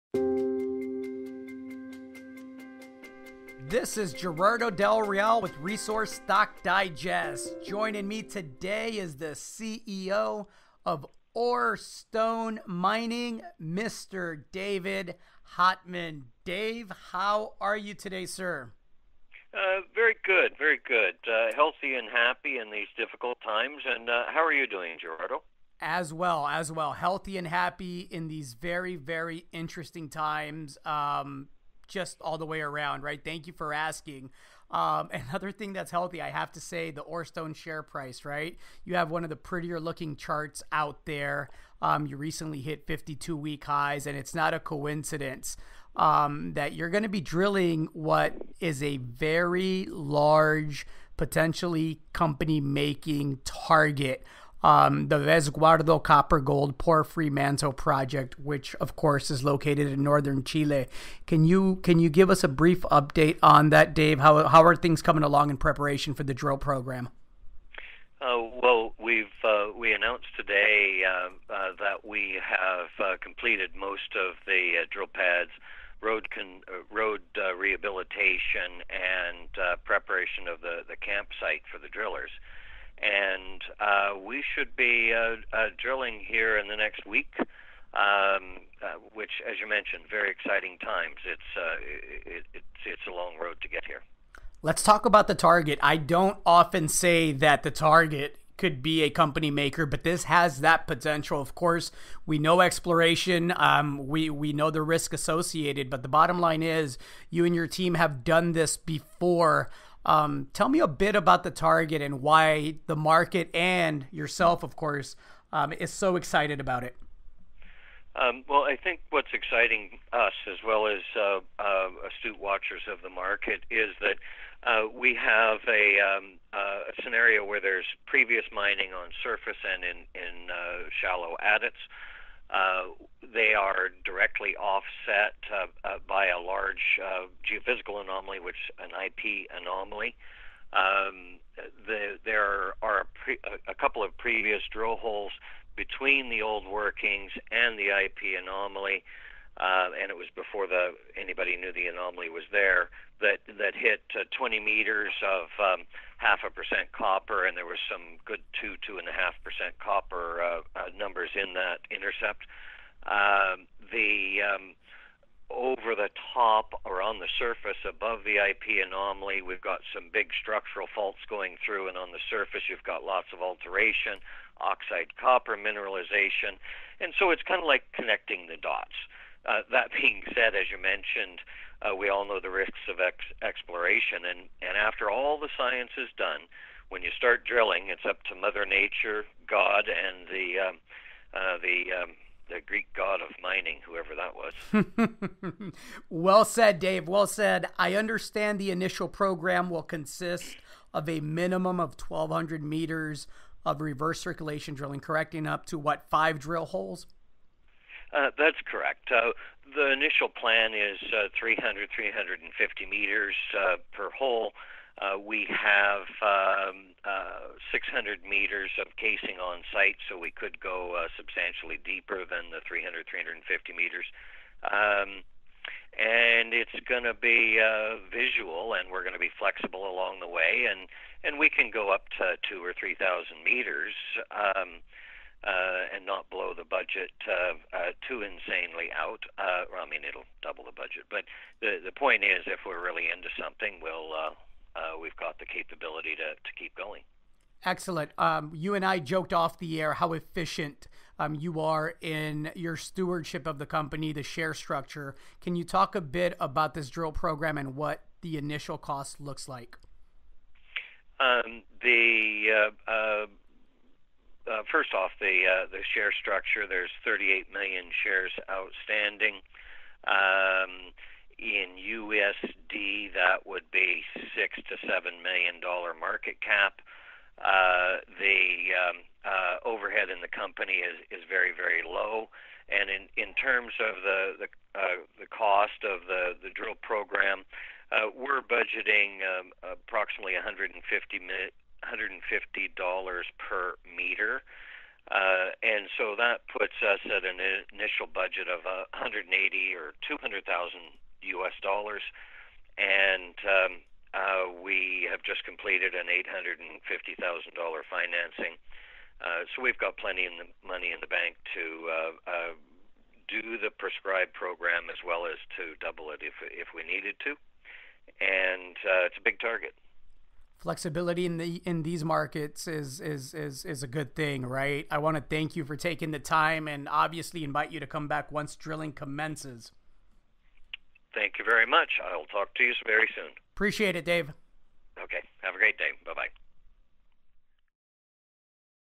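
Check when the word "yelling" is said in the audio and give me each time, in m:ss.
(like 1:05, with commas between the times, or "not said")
not said.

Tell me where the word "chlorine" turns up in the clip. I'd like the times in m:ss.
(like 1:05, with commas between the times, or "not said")
not said.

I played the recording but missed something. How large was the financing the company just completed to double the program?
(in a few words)
$850,000.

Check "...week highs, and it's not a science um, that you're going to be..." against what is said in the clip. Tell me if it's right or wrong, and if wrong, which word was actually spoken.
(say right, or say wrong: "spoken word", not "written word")
wrong: "coincidence", not "science".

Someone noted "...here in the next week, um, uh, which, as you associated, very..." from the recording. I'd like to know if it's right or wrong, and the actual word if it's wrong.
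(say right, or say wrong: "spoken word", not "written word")
wrong: "mentioned", not "associated".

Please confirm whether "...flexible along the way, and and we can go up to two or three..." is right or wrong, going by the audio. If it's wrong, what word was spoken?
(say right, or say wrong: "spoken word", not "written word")
right.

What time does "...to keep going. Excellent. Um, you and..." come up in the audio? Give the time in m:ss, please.
4:06.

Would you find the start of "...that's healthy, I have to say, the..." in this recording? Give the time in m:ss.
0:35.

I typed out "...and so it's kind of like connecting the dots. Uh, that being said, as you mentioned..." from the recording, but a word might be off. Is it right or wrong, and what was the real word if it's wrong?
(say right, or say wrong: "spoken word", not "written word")
right.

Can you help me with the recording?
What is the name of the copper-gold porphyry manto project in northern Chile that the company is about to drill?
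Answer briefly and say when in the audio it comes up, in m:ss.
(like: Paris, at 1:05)
Resguardo, at 0:55.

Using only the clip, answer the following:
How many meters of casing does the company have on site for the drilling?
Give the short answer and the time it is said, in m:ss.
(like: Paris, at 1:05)
600 meters, at 3:37.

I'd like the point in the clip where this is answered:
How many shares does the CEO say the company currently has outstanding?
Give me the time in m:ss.
4:27.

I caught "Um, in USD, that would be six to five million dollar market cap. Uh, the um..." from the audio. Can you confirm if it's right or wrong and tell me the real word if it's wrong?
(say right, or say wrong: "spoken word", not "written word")
wrong: "seven", not "five".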